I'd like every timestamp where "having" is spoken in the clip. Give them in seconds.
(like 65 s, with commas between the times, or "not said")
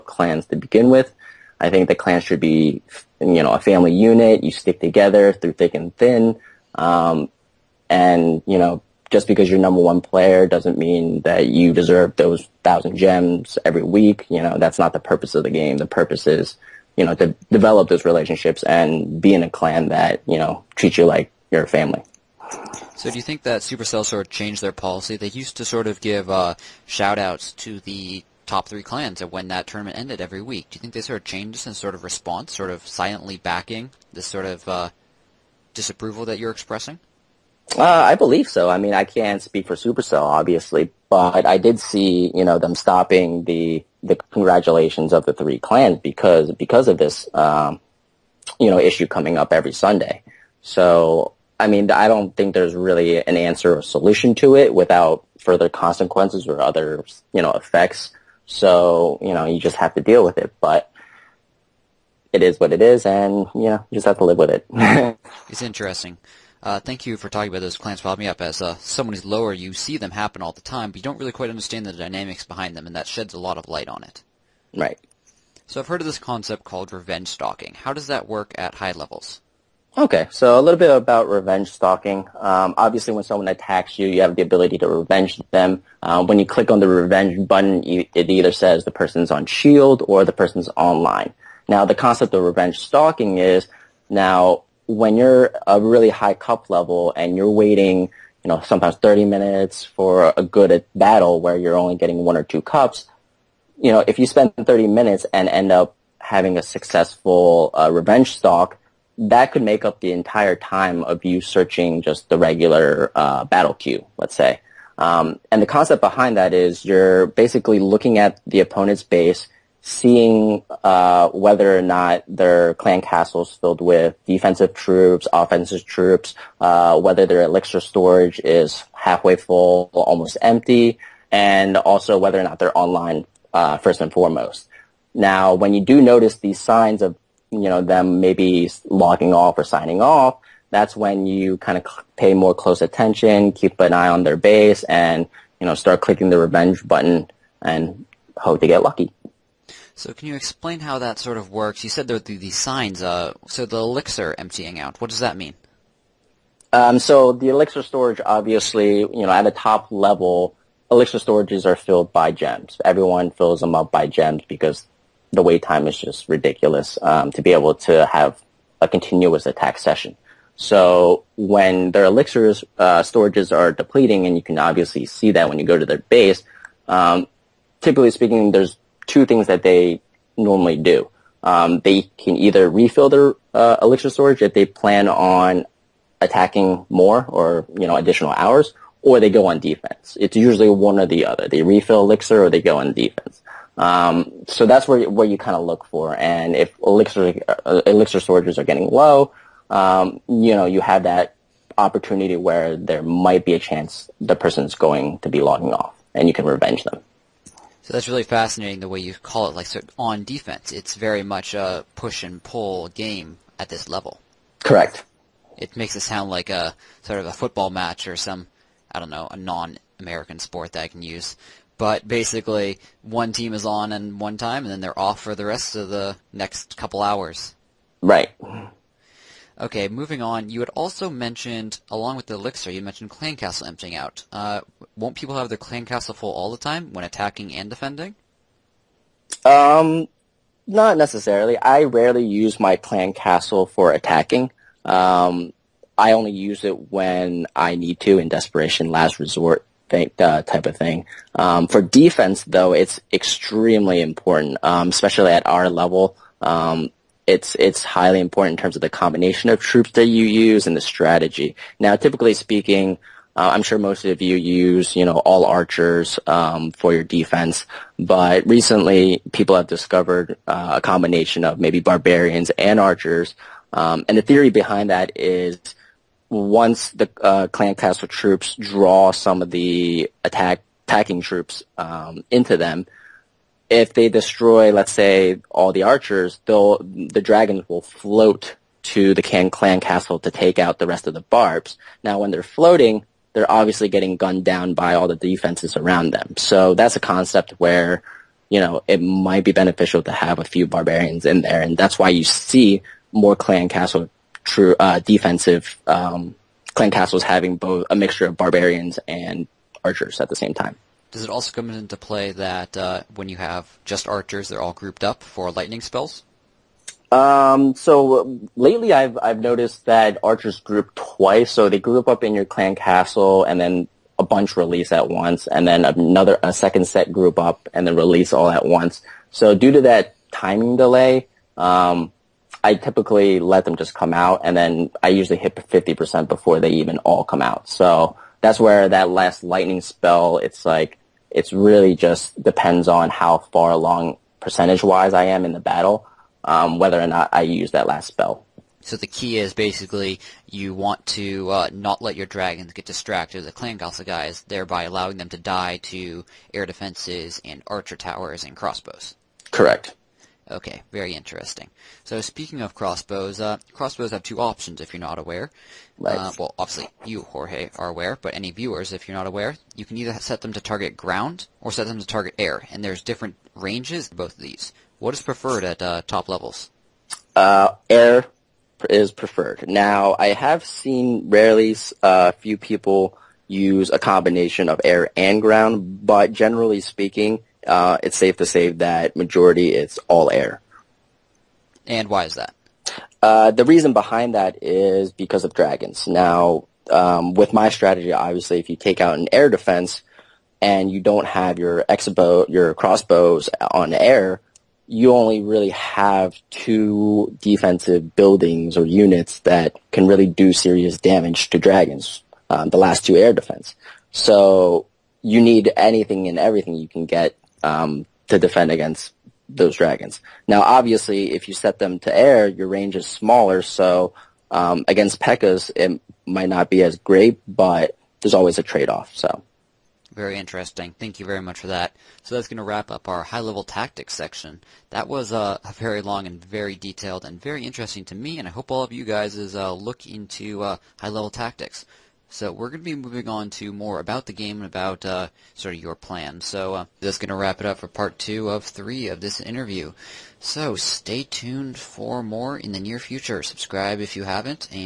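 106 s, 307 s.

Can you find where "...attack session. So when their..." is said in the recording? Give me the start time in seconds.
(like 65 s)
169 s.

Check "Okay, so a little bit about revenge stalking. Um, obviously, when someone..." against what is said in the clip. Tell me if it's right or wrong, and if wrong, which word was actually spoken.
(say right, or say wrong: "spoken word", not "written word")
right.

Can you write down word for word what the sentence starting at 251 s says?
Um, for defense, though, it's extremely important, um, especially at our level.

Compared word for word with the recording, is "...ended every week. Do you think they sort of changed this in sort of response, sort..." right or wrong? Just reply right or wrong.
right.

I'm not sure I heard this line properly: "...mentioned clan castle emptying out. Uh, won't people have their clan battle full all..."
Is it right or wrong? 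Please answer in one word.
wrong.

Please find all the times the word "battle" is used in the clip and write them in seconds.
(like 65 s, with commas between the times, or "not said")
100 s, 113 s, 345 s.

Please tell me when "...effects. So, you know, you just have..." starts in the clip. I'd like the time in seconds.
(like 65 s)
57 s.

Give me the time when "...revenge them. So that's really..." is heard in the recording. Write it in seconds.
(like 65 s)
206 s.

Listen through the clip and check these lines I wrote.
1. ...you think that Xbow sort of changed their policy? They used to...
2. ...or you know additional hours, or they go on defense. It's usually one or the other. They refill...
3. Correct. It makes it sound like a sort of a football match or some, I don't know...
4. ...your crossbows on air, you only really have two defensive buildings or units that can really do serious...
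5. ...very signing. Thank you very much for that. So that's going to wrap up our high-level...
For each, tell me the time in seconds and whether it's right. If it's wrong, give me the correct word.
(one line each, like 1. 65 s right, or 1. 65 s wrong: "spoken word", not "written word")
1. 23 s wrong: "Supercell", not "Xbow"
2. 187 s right
3. 214 s right
4. 402 s right
5. 430 s wrong: "interesting", not "signing".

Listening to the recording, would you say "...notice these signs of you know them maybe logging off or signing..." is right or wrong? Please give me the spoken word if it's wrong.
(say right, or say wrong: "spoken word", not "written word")
right.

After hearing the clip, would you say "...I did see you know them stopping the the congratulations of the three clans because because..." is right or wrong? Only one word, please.
right.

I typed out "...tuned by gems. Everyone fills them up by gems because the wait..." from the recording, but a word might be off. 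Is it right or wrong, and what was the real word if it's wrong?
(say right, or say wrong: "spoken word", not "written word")
wrong: "filled", not "tuned".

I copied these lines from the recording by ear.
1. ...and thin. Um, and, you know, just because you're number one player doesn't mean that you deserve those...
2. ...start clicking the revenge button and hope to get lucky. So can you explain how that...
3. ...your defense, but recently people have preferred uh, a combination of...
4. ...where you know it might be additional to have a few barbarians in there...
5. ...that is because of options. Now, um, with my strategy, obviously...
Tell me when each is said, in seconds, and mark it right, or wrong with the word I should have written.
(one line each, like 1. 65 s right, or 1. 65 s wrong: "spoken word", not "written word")
1. 5 s right
2. 145 s right
3. 266 s wrong: "discovered", not "preferred"
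4. 297 s wrong: "beneficial", not "additional"
5. 394 s wrong: "dragons", not "options".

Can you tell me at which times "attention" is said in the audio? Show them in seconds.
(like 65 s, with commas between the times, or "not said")
142 s.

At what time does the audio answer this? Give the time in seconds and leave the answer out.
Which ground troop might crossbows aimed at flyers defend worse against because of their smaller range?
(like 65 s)
425 s.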